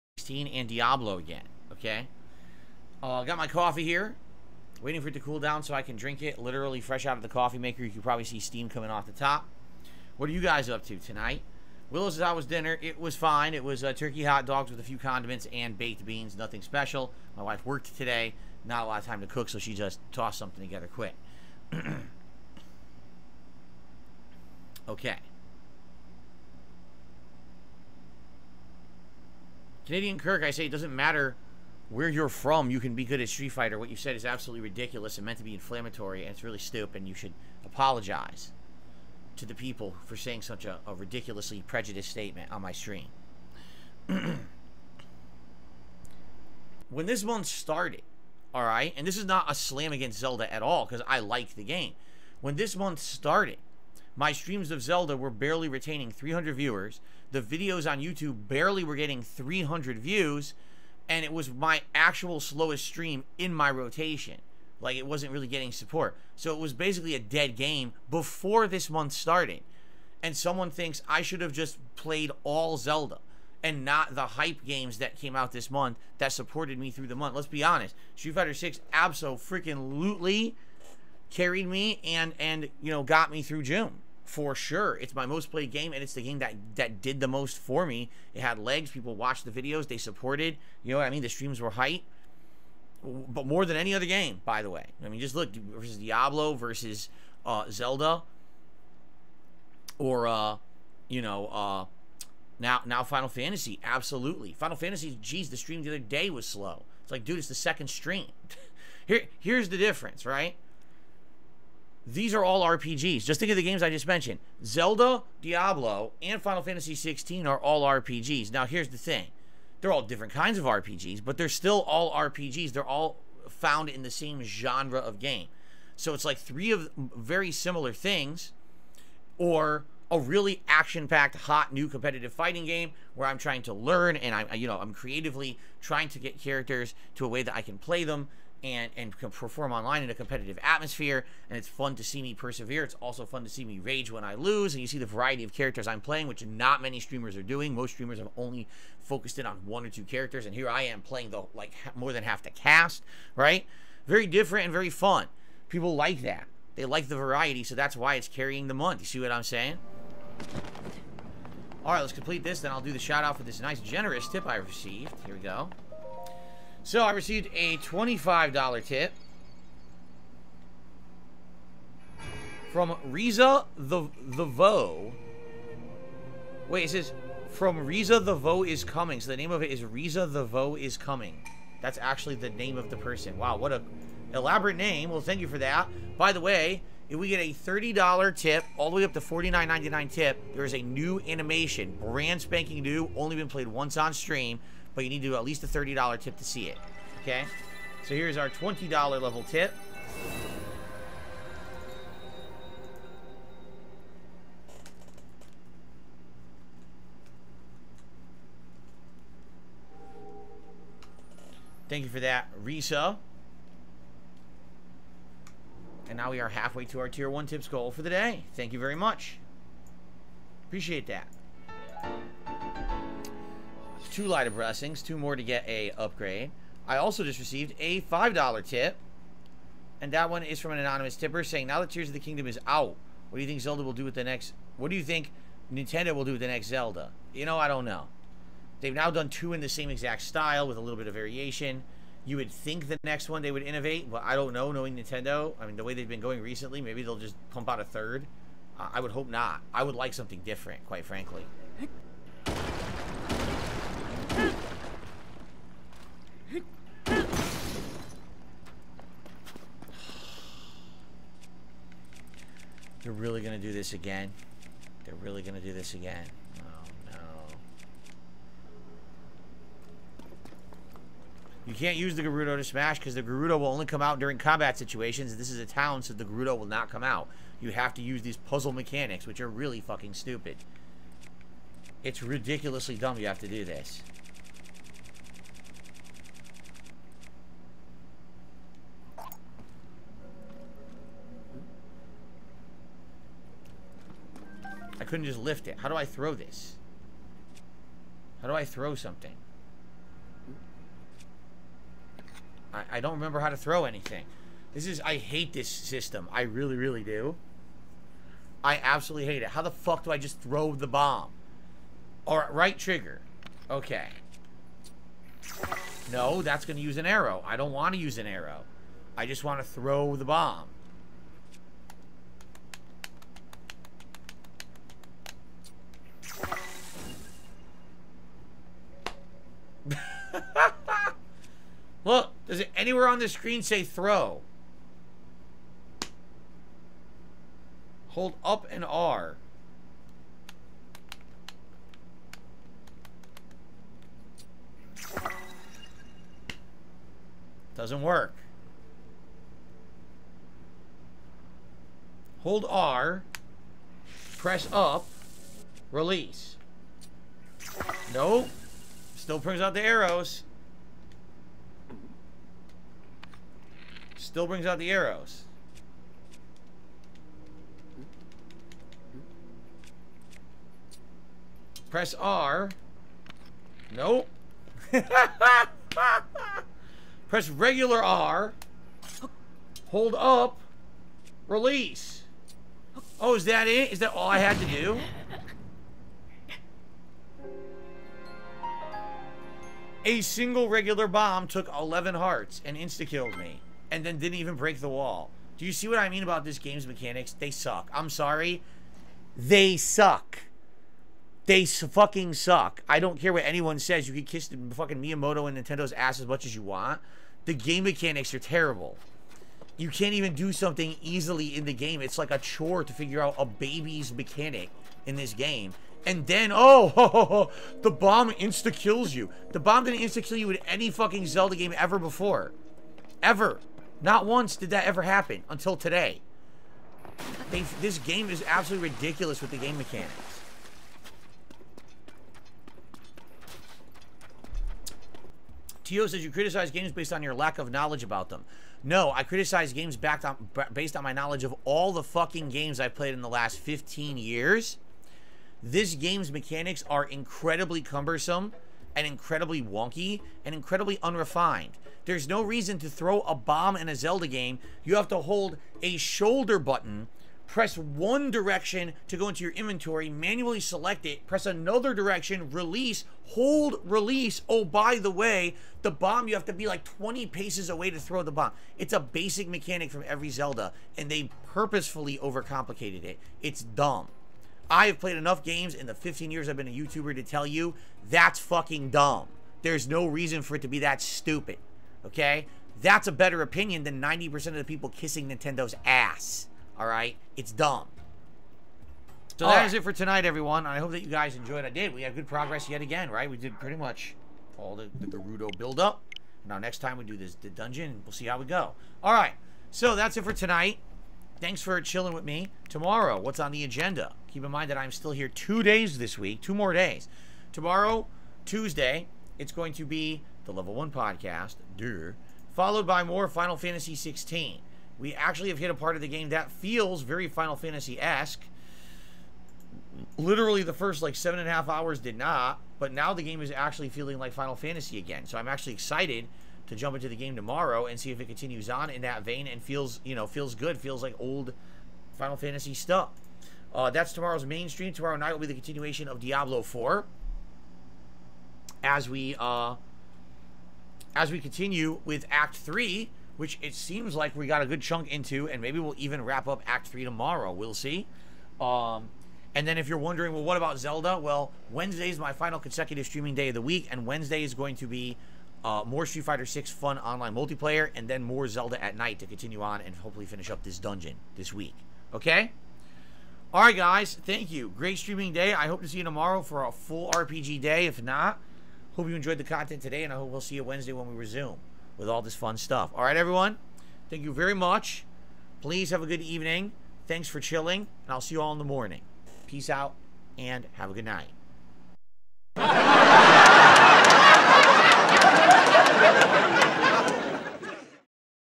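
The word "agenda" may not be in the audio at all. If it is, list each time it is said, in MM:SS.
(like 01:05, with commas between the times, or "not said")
08:23.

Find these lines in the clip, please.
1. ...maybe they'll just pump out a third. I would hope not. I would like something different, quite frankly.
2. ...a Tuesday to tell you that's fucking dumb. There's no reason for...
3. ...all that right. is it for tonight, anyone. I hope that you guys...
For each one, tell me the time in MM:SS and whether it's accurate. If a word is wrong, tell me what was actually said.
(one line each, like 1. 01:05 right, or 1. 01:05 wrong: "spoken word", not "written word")
1. 04:06 right
2. 07:56 wrong: "YouTuber", not "Tuesday"
3. 08:09 wrong: "everyone", not "anyone".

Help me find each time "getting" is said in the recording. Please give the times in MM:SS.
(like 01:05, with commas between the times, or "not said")
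00:58, 01:05.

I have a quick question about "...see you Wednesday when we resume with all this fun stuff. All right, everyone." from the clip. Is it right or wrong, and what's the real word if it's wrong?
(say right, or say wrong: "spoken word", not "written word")
right.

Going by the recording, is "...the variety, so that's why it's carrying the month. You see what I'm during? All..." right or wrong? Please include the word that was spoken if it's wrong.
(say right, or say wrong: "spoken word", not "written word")
wrong: "saying", not "during".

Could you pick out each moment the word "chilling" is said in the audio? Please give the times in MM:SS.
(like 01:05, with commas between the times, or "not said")
08:21, 09:37.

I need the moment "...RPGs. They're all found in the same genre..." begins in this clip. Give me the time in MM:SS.
02:02.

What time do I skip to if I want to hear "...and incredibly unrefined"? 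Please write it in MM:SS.
07:30.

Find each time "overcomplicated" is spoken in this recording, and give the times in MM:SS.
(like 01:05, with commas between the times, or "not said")
07:52.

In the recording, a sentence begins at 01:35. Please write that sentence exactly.
I mean, just look versus Diablo versus uh, Zelda, or uh, you know, uh, now now Final Fantasy.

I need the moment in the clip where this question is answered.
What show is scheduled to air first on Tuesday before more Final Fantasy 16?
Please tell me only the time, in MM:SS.
08:30.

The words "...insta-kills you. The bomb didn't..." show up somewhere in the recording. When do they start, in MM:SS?
06:58.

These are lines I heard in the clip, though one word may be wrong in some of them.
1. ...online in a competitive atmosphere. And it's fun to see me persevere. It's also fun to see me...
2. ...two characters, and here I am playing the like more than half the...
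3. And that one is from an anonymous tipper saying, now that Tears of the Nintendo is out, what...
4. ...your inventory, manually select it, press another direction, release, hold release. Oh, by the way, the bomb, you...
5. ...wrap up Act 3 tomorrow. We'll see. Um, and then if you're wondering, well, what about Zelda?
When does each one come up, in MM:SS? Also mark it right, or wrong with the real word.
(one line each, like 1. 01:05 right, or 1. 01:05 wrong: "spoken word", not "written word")
1. 02:19 right
2. 02:29 right
3. 03:49 wrong: "Kingdom", not "Nintendo"
4. 07:39 right
5. 09:06 right.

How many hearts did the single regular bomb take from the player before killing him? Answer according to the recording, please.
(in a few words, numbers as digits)
11.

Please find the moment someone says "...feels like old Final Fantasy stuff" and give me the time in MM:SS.
08:50.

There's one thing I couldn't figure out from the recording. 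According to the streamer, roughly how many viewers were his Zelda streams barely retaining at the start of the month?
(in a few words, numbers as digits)
300.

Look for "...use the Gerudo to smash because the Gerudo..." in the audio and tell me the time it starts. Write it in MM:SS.
04:31.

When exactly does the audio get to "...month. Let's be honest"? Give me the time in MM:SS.
01:17.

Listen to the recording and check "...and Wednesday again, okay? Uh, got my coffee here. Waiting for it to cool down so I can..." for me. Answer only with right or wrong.
wrong.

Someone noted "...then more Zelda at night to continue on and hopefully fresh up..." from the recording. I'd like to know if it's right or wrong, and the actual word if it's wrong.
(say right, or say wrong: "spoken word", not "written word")
wrong: "finish", not "fresh".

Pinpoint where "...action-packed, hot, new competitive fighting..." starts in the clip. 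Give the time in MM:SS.
02:10.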